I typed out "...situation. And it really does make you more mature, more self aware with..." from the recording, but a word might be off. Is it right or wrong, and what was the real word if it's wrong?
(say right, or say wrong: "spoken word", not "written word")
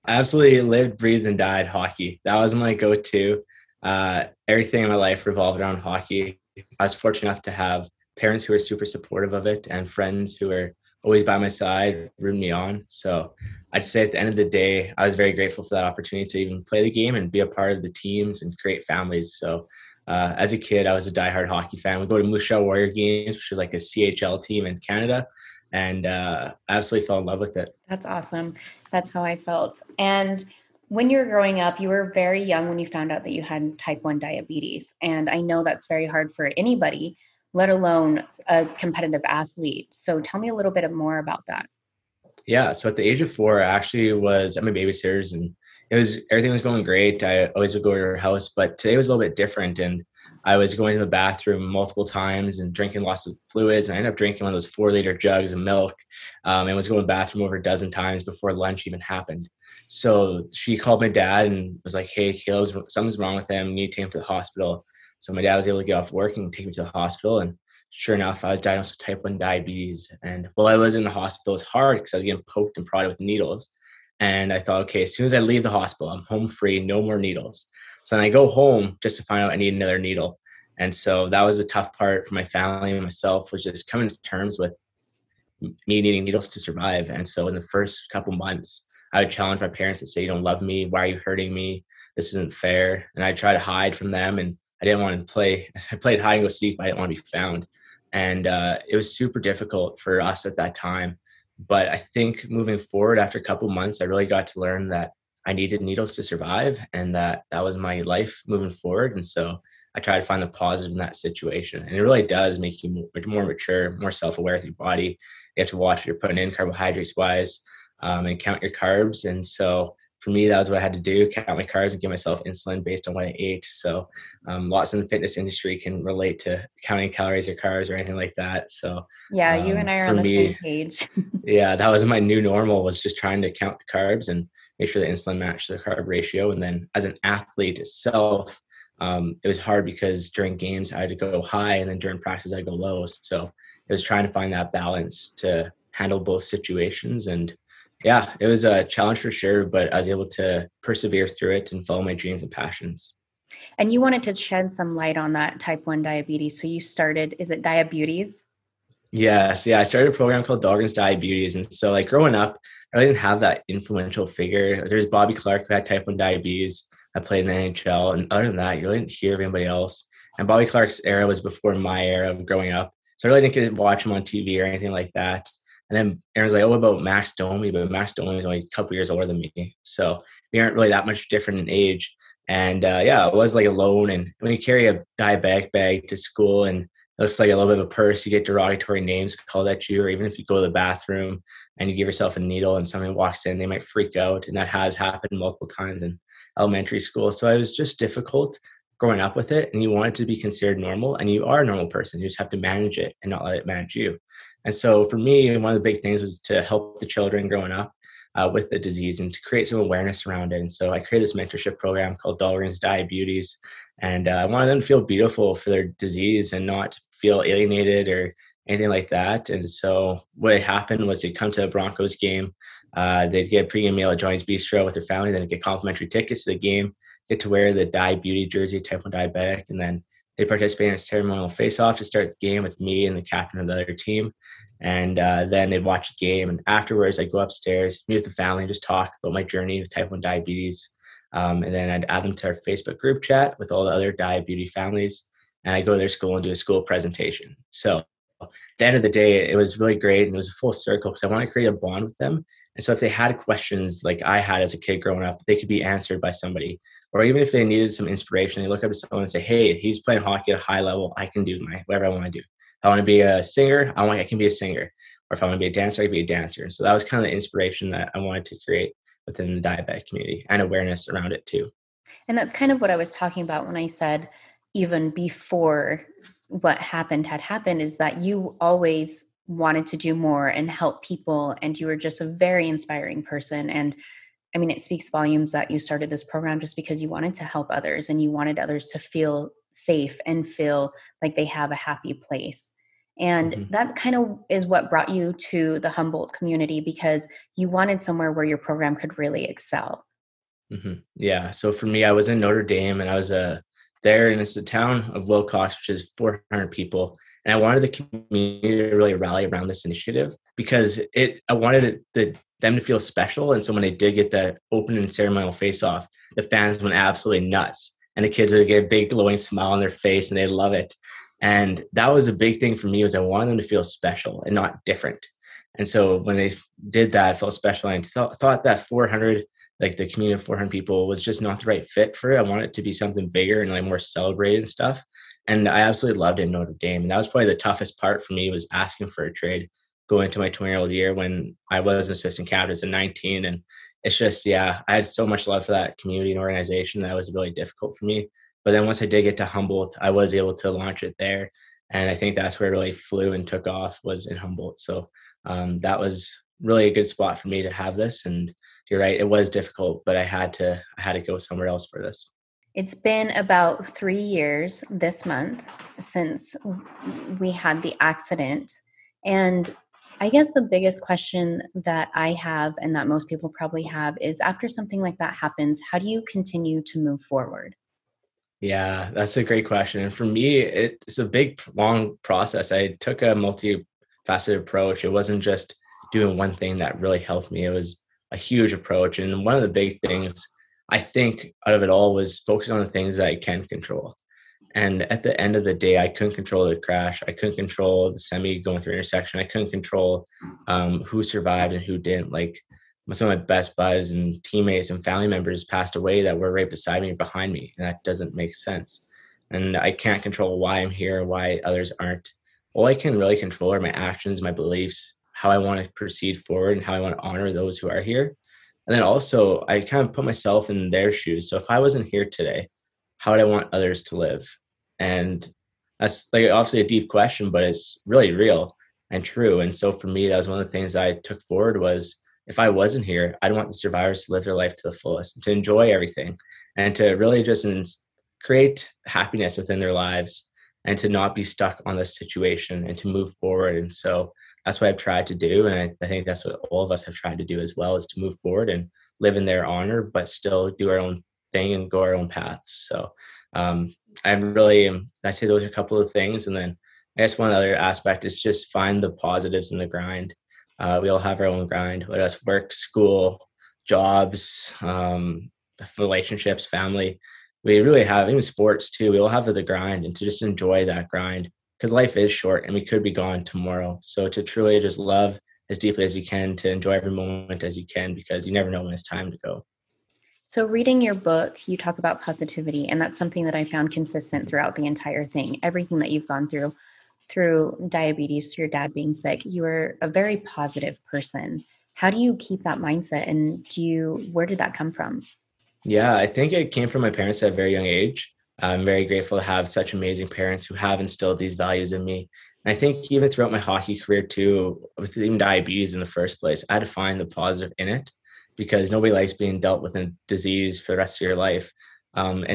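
right.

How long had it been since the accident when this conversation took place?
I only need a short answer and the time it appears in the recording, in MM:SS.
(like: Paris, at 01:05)
3 years, at 06:03.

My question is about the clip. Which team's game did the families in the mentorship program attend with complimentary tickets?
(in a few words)
Broncos.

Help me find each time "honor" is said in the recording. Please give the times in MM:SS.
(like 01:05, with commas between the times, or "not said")
06:57, 07:29.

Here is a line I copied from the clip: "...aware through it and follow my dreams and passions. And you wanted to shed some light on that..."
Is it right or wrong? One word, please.
wrong.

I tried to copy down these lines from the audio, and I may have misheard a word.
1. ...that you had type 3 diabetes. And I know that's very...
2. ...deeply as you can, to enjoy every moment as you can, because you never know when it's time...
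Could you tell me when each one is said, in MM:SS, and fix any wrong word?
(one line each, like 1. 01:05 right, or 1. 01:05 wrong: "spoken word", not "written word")
1. 00:33 wrong: "1", not "3"
2. 07:55 right.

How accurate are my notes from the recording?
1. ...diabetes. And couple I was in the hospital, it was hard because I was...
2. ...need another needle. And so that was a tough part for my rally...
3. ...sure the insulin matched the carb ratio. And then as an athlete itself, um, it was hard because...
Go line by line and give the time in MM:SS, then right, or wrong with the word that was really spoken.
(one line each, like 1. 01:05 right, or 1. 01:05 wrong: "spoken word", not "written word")
1. 01:09 wrong: "while", not "couple"
2. 01:19 wrong: "family", not "rally"
3. 02:14 right.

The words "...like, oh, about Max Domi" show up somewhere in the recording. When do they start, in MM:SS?
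02:56.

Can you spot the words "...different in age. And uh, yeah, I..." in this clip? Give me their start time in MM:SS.
03:01.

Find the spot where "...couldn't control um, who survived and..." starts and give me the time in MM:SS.
06:39.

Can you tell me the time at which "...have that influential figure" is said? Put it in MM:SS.
02:43.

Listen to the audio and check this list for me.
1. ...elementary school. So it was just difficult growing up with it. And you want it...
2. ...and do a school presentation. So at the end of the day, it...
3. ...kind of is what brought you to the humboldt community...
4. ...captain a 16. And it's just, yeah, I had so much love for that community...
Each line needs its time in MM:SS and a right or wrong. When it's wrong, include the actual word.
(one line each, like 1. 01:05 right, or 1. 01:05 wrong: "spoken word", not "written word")
1. 03:16 right
2. 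04:06 right
3. 04:53 right
4. 05:42 wrong: "19", not "16".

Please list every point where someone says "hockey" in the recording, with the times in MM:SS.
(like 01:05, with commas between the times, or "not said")
00:01, 00:05, 00:21, 04:20, 08:23.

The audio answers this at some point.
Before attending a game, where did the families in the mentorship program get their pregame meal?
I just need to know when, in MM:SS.
03:44.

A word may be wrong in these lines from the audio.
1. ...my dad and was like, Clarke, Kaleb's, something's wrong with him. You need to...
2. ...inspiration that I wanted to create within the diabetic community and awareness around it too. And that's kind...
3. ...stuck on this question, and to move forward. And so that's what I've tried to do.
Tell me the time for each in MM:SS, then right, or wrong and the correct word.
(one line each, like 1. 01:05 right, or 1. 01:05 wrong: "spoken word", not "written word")
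1. 01:00 wrong: "Hey", not "Clarke"
2. 04:27 right
3. 07:21 wrong: "situation", not "question".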